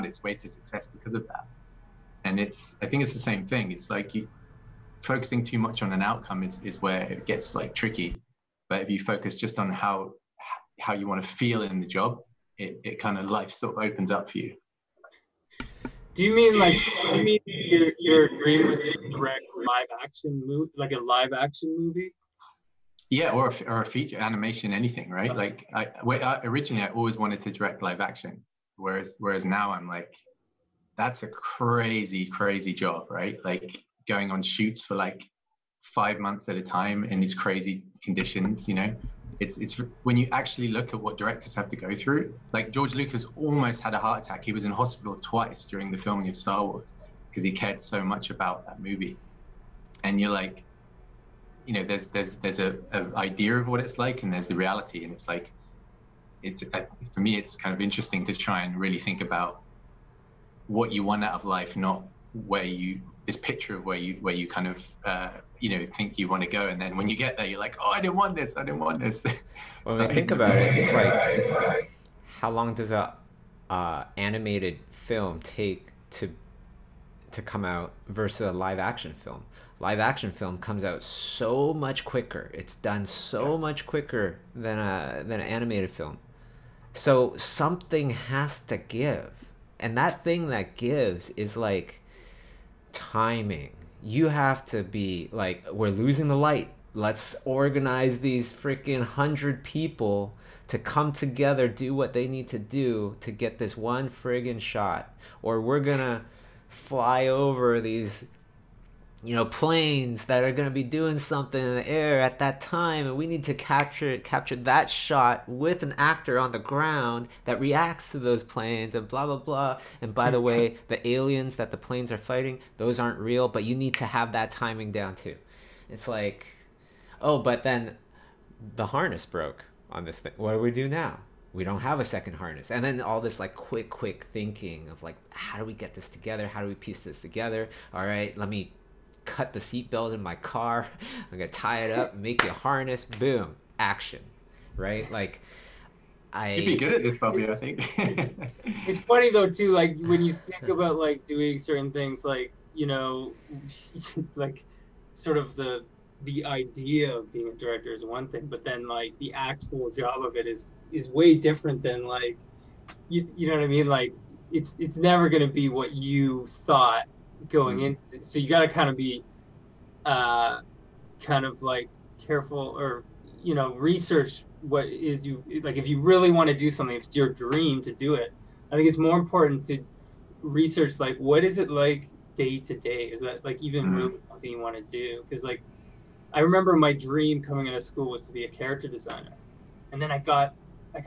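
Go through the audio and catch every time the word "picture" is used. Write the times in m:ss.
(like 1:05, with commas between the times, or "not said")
1:03.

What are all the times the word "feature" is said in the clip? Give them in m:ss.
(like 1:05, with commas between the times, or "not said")
0:23.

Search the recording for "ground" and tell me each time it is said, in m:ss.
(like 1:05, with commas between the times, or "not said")
1:56.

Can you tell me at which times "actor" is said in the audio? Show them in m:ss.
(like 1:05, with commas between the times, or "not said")
1:55.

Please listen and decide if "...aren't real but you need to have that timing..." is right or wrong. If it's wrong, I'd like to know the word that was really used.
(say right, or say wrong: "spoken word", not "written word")
right.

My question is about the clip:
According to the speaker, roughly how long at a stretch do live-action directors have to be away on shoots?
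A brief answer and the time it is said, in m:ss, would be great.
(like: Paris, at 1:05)
5 months, at 0:35.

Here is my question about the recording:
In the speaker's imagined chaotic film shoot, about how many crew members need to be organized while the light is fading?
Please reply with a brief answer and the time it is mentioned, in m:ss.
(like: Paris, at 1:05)
100, at 1:39.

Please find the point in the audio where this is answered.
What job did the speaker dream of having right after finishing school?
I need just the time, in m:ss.
3:08.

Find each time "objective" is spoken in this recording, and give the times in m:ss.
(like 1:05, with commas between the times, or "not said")
not said.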